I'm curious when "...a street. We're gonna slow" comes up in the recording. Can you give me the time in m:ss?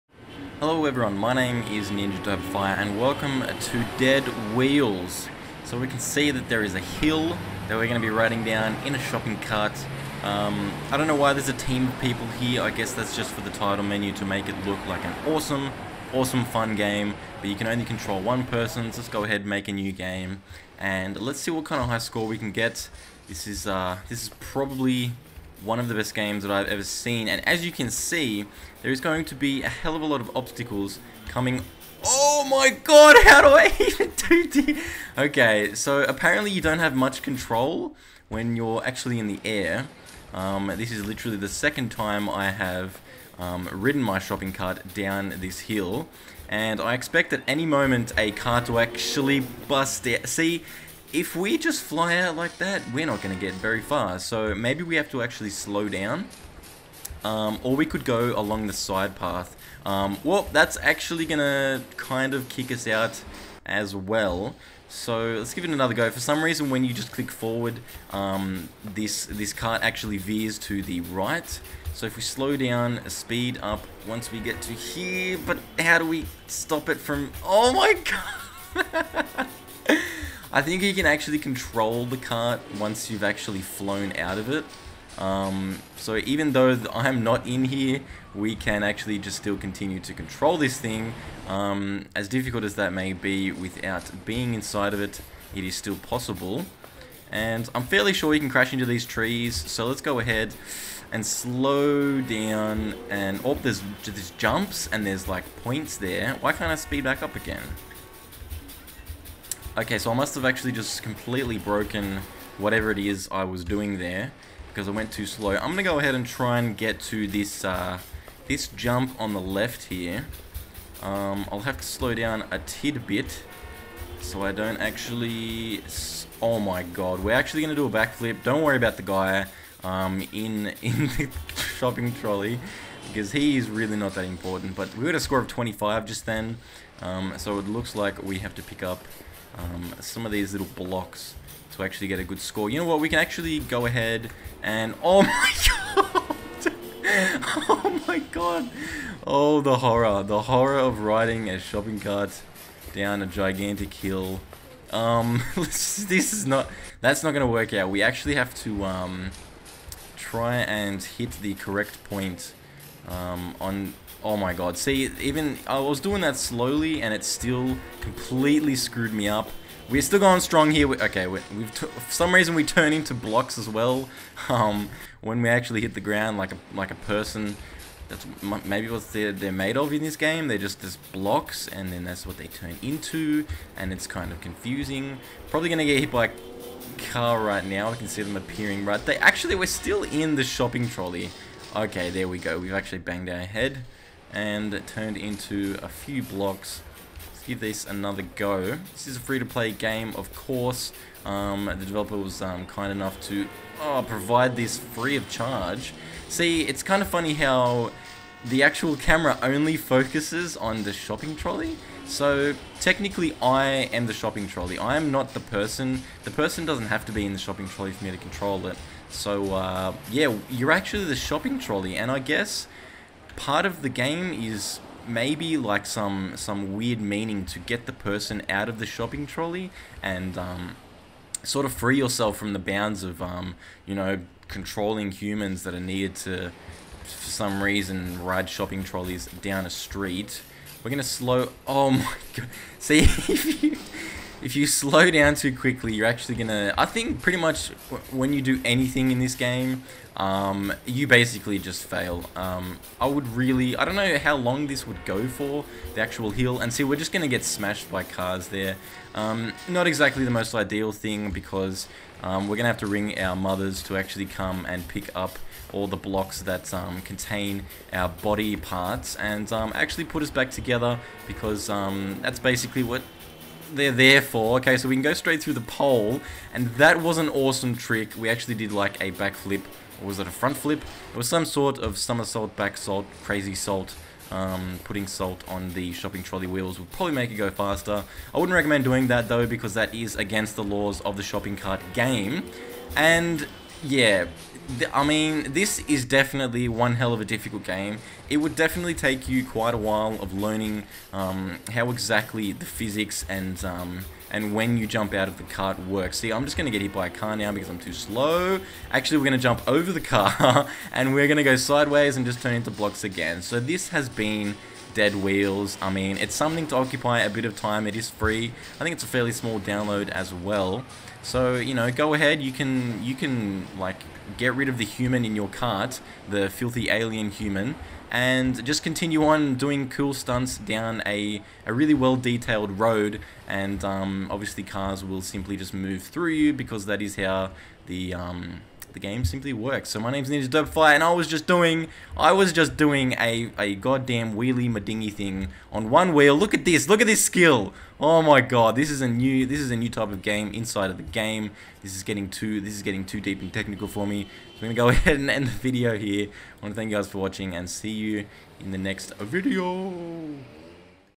3:59.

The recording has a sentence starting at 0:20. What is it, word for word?
And let's see what kind of high score we can get.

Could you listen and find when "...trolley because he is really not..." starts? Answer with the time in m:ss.
2:12.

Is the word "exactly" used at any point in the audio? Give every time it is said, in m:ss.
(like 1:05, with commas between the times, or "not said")
4:19, 5:01.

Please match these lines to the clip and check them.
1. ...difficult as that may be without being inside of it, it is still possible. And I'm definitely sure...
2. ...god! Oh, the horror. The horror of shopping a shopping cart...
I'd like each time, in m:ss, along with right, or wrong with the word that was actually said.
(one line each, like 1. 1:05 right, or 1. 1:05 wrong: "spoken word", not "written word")
1. 1:32 wrong: "fairly", not "definitely"
2. 2:28 wrong: "riding", not "shopping".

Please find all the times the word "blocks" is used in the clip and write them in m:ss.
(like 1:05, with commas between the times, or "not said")
2:20, 2:53, 3:01, 3:16, 4:25, 5:12.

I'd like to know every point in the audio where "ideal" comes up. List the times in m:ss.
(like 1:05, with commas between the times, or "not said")
4:20.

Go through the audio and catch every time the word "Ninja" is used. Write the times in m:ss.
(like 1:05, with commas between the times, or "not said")
0:01, 5:40.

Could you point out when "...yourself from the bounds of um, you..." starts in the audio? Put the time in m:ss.
3:51.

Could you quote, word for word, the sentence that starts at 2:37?
That's not going to work out.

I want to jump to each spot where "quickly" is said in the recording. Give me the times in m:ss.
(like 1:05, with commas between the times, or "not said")
4:05.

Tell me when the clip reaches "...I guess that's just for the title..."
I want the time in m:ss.
0:12.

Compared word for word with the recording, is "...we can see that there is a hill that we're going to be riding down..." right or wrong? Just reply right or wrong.
right.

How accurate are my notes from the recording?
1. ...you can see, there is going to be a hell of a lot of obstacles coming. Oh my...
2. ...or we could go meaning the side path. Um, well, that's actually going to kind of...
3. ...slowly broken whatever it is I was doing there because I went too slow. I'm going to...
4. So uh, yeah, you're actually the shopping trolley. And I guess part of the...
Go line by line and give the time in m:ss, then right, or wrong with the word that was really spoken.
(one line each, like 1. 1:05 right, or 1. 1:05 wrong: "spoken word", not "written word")
1. 0:27 right
2. 0:57 wrong: "along", not "meaning"
3. 1:51 wrong: "completely", not "slowly"
4. 3:39 right.